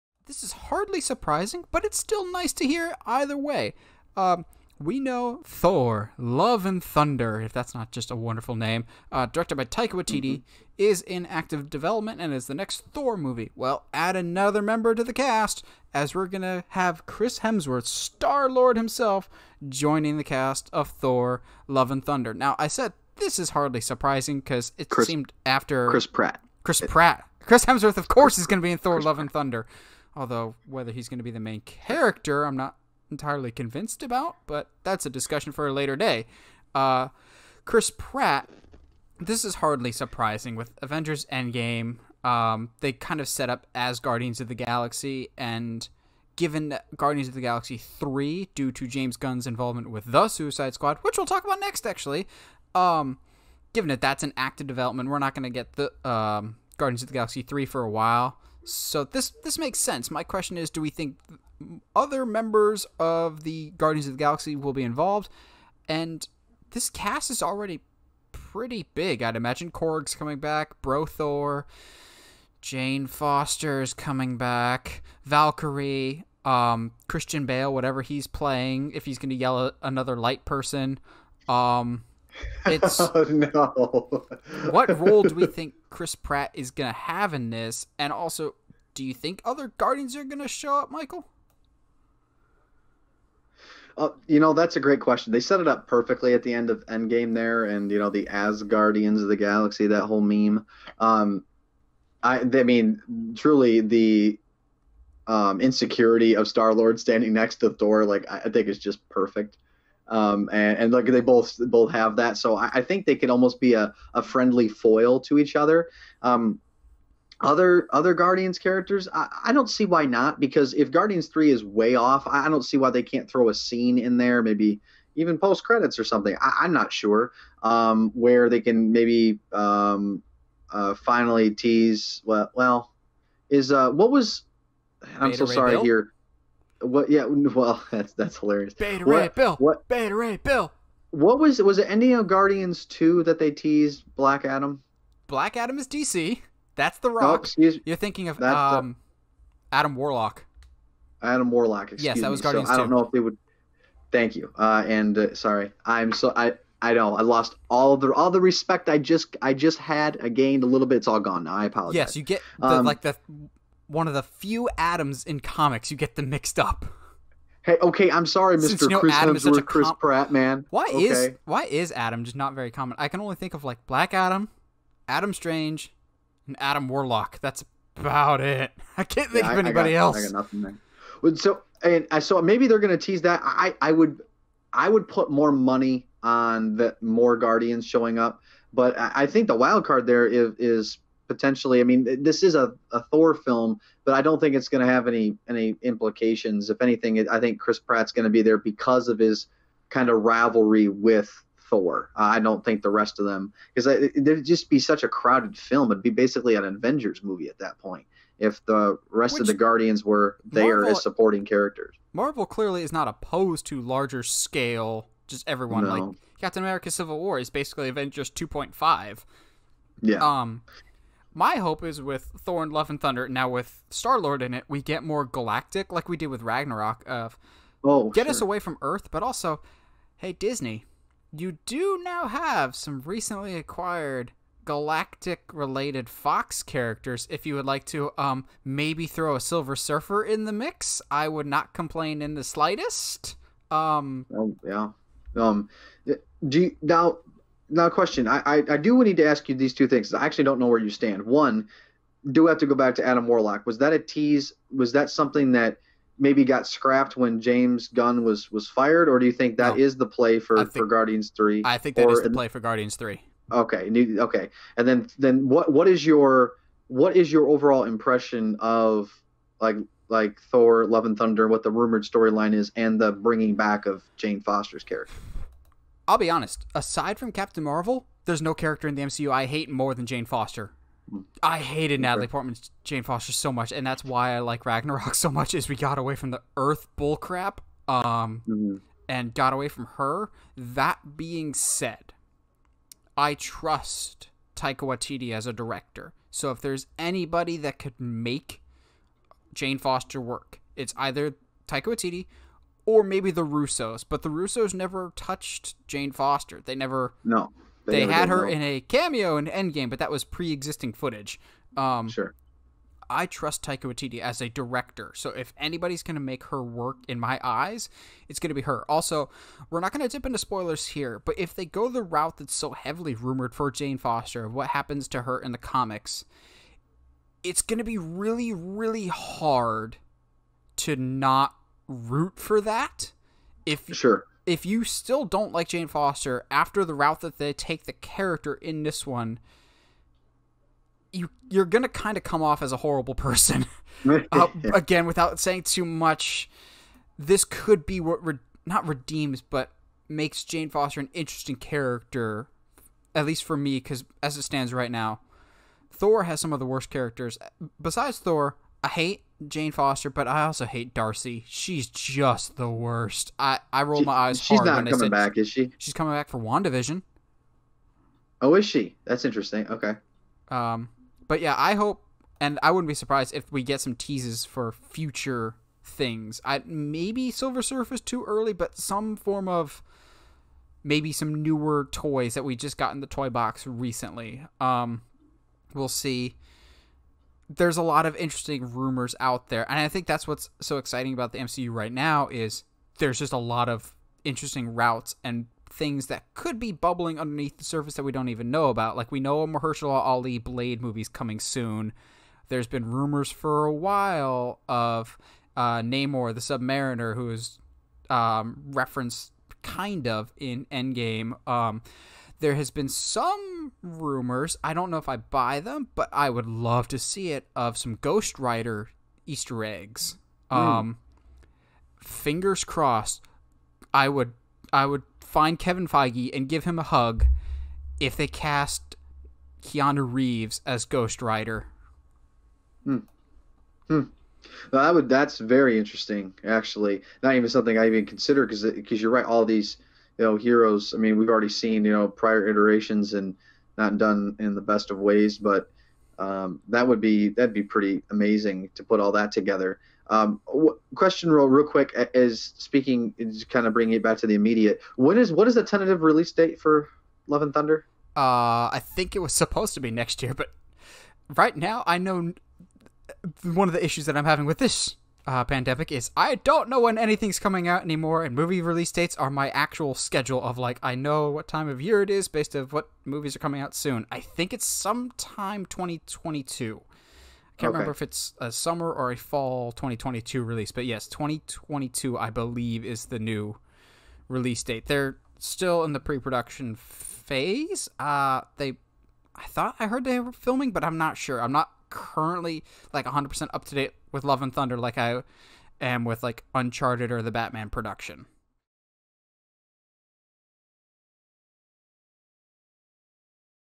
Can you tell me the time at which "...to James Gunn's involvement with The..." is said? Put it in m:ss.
0:48.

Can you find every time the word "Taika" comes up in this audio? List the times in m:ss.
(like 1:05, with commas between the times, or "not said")
0:09, 4:54, 5:01, 5:13.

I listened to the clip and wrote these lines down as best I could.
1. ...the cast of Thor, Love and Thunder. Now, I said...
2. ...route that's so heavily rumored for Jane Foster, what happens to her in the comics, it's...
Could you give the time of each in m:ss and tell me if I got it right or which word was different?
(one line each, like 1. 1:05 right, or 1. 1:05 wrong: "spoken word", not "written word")
1. 0:20 right
2. 5:22 right.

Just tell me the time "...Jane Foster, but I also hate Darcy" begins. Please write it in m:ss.
5:59.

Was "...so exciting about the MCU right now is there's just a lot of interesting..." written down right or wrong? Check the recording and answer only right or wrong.
right.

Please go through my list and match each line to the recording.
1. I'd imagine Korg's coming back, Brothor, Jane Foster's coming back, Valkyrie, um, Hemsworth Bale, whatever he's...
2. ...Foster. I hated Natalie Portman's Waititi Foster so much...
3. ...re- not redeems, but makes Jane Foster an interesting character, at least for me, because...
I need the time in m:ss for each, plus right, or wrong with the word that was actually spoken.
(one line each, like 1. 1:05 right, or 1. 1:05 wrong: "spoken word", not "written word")
1. 1:09 wrong: "Christian", not "Hemsworth"
2. 4:40 wrong: "Jane", not "Waititi"
3. 5:48 right.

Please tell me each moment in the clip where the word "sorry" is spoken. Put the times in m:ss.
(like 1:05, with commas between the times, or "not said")
2:15, 2:35, 2:48.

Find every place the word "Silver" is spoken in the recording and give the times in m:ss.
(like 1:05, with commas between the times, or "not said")
3:59, 6:17.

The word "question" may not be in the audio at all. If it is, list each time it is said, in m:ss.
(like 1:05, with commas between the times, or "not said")
1:00, 1:35, 4:07, 7:30.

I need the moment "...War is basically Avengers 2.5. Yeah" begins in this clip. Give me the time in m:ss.
3:37.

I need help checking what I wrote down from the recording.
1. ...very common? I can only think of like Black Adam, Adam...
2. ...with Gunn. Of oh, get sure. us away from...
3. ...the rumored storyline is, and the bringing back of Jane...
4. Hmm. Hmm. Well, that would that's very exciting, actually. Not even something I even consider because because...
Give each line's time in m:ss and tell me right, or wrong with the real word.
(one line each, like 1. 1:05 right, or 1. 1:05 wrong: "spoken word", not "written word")
1. 2:52 right
2. 3:46 wrong: "Ragnarok", not "Gunn"
3. 4:31 right
4. 7:12 wrong: "interesting", not "exciting".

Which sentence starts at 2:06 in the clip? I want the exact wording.
I, am not sure um, where they can maybe um, uh, finally tease.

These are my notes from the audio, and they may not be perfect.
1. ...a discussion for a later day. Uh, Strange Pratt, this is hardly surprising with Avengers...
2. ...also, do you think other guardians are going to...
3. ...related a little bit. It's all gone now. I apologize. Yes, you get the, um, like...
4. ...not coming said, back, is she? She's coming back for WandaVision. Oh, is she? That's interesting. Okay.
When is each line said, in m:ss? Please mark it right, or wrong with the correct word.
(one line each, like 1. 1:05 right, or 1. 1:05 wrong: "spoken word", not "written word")
1. 0:35 wrong: "Chris", not "Strange"
2. 1:28 right
3. 2:40 wrong: "gained", not "related"
4. 6:04 right.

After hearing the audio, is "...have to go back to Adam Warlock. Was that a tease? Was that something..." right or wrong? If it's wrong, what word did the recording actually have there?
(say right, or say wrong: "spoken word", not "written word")
right.